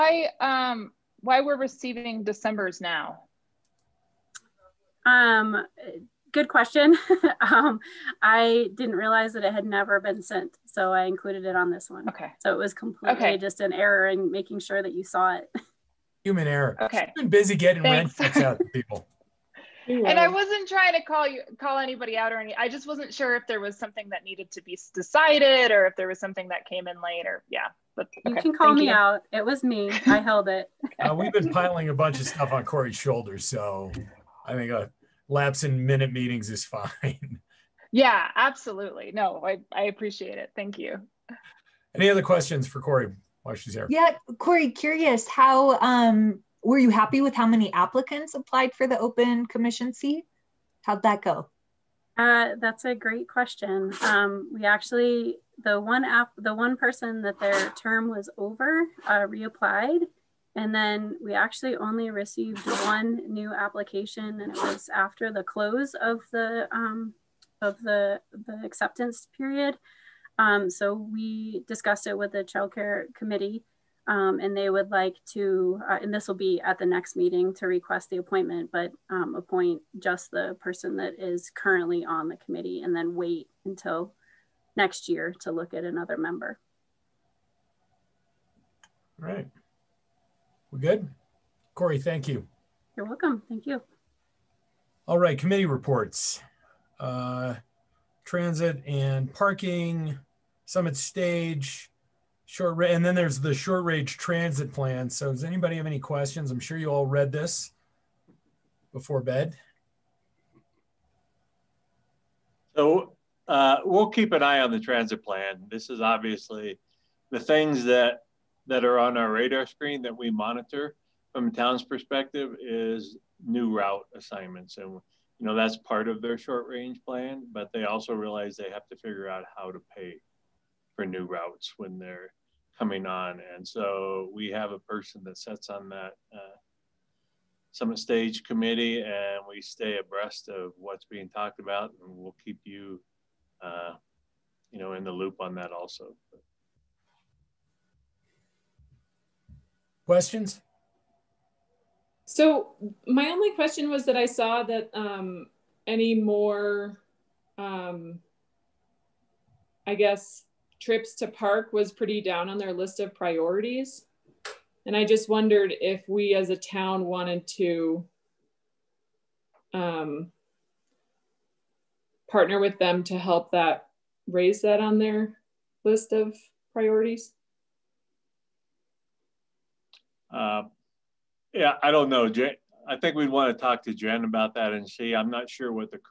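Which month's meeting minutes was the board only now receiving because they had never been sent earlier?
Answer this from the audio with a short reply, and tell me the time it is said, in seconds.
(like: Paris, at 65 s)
December, at 2 s.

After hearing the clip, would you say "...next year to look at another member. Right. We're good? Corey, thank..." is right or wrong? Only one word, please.
right.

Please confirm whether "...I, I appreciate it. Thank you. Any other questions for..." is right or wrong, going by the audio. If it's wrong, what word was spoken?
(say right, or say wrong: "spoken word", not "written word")
right.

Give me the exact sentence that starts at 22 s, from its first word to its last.
I just wasn't sure if there was something that needed to be decided or if there was something that came in later.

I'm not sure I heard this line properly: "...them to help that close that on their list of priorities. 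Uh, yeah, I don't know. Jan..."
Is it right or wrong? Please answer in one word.
wrong.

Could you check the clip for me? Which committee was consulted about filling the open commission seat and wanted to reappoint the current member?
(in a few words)
childcare committee.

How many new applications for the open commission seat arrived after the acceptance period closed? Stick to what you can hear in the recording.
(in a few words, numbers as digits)
1.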